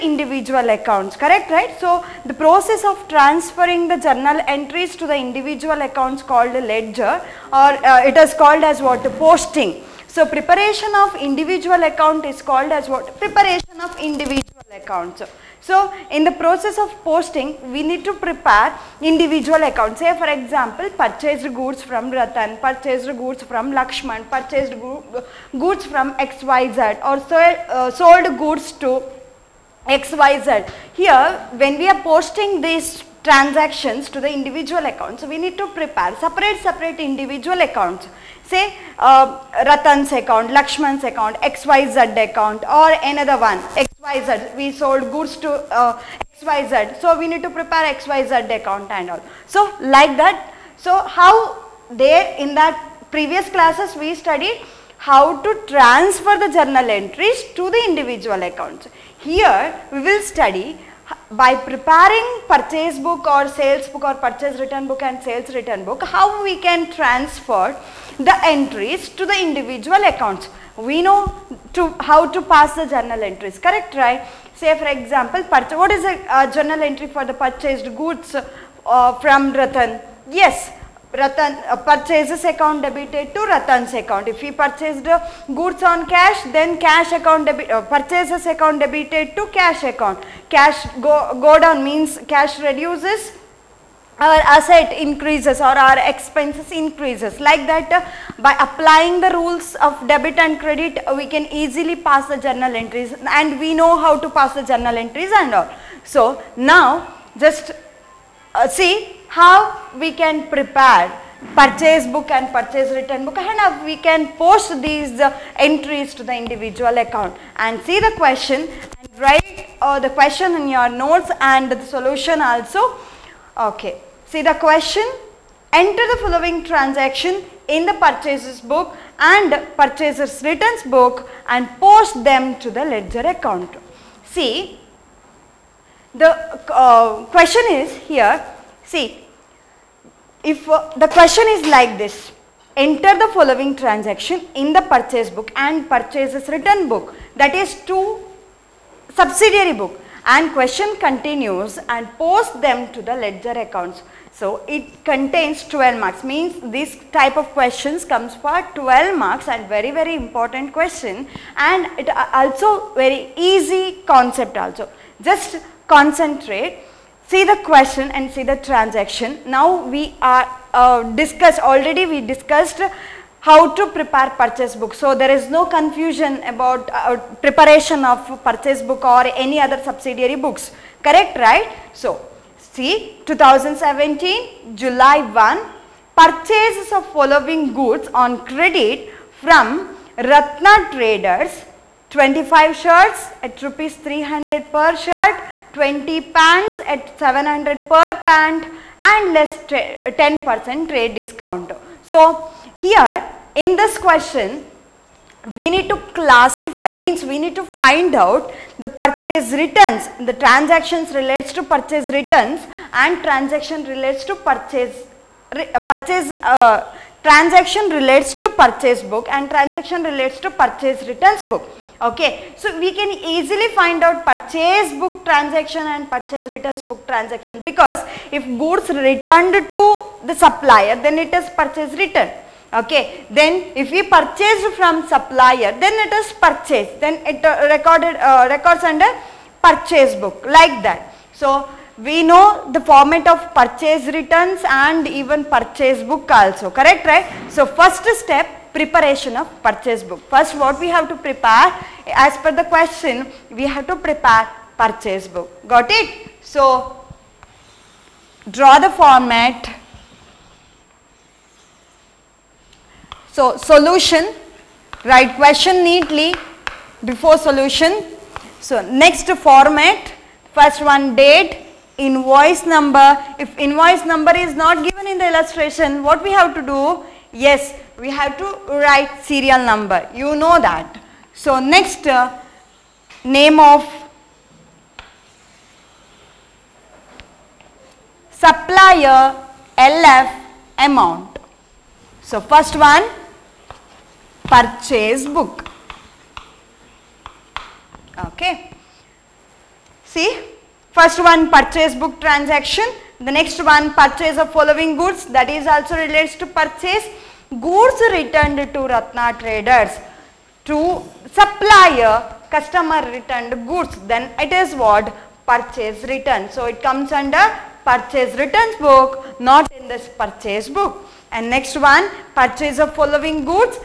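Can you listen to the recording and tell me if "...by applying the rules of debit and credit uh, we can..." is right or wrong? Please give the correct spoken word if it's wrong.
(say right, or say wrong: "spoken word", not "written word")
right.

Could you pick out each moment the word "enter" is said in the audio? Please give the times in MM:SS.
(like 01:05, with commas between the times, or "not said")
02:05, 02:22.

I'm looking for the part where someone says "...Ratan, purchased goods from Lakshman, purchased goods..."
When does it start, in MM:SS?
00:22.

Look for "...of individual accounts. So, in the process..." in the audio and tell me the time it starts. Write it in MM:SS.
00:13.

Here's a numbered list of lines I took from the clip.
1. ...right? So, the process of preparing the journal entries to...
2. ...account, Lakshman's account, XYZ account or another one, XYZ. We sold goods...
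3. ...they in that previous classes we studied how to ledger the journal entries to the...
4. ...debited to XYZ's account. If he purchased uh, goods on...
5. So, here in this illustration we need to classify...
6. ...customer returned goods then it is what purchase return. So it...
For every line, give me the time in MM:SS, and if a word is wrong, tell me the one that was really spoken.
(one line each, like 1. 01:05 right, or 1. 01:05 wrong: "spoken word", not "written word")
1. 00:01 wrong: "transferring", not "preparing"
2. 00:40 right
3. 00:51 wrong: "transfer", not "ledger"
4. 01:22 wrong: "Ratan", not "XYZ"
5. 03:22 wrong: "question", not "illustration"
6. 05:12 right.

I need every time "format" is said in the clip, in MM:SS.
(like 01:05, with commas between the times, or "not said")
04:02, 04:19, 04:29.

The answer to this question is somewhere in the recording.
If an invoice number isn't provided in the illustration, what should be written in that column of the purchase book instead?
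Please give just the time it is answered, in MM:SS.
04:39.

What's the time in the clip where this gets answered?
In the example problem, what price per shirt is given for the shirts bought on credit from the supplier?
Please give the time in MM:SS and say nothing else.
03:13.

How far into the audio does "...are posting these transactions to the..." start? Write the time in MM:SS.
00:31.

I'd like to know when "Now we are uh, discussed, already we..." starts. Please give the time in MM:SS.
02:49.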